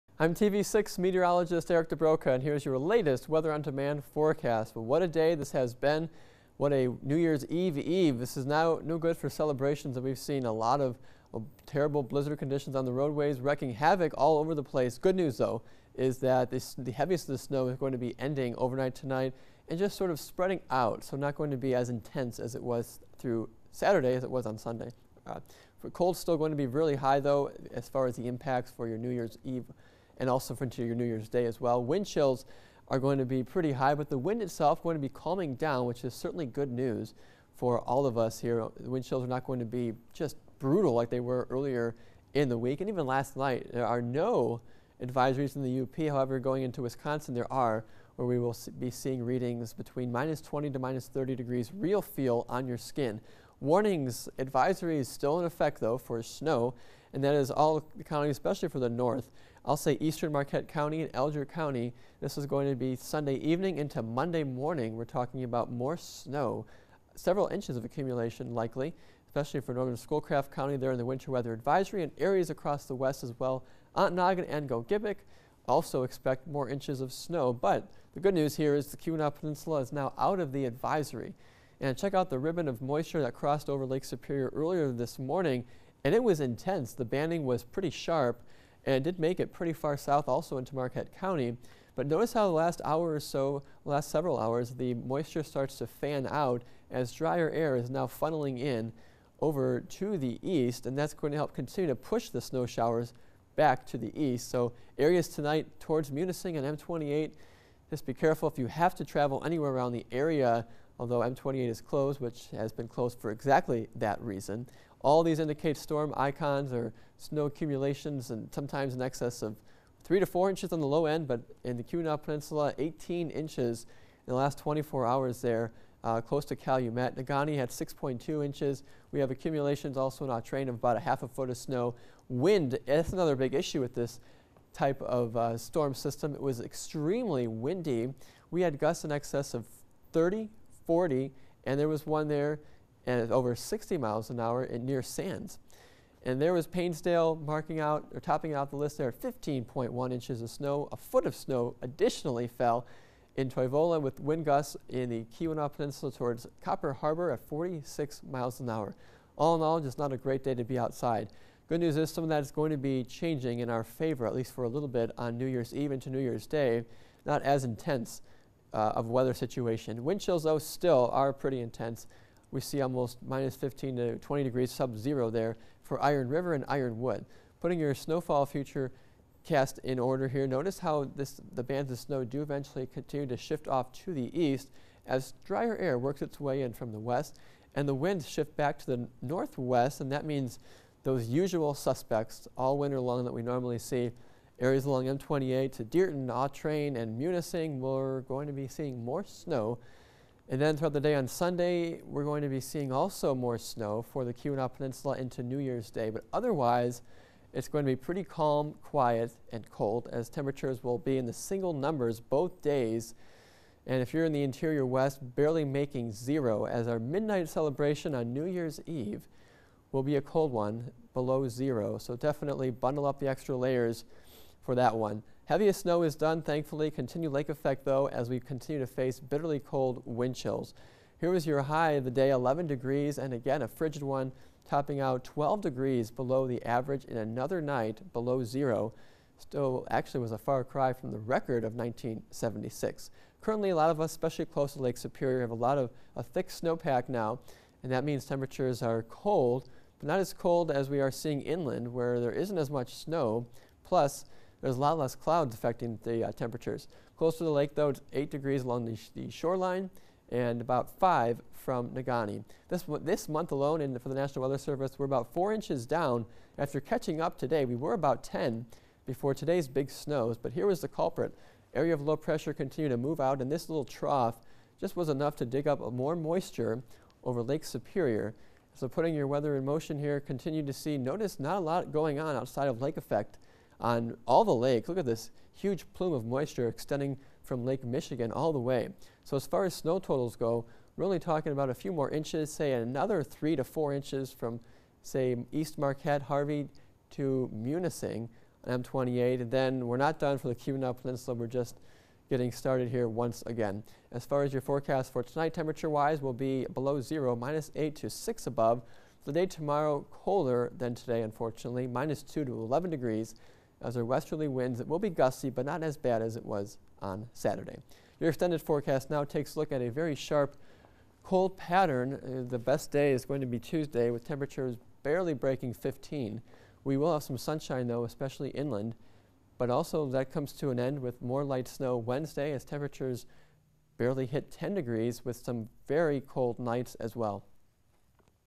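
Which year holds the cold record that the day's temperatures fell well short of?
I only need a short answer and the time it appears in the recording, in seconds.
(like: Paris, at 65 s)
1976, at 241 s.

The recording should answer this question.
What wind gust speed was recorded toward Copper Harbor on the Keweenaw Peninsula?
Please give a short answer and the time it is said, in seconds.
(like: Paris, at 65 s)
46 miles an hour, at 157 s.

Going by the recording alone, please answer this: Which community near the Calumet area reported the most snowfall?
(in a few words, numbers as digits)
Painesdale.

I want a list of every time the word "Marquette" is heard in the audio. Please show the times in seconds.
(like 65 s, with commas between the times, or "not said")
60 s, 90 s, 295 s.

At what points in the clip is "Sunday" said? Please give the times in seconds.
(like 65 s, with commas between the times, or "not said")
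24 s, 62 s, 201 s.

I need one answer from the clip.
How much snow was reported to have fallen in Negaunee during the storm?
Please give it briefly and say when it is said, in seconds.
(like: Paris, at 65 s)
6.2 inches, at 127 s.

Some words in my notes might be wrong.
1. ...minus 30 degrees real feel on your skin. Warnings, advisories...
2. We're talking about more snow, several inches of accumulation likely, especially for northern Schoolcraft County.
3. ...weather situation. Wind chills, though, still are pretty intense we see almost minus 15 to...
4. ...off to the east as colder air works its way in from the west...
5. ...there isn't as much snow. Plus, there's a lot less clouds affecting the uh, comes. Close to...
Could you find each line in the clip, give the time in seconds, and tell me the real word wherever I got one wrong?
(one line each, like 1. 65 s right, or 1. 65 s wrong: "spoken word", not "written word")
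1. 50 s right
2. 64 s right
3. 169 s right
4. 183 s wrong: "drier", not "colder"
5. 252 s wrong: "temperatures", not "comes".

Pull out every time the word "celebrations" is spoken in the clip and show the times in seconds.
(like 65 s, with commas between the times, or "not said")
9 s, 217 s.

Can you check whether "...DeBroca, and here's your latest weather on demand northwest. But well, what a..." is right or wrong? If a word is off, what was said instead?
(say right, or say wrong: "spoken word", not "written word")
wrong: "forecast", not "northwest".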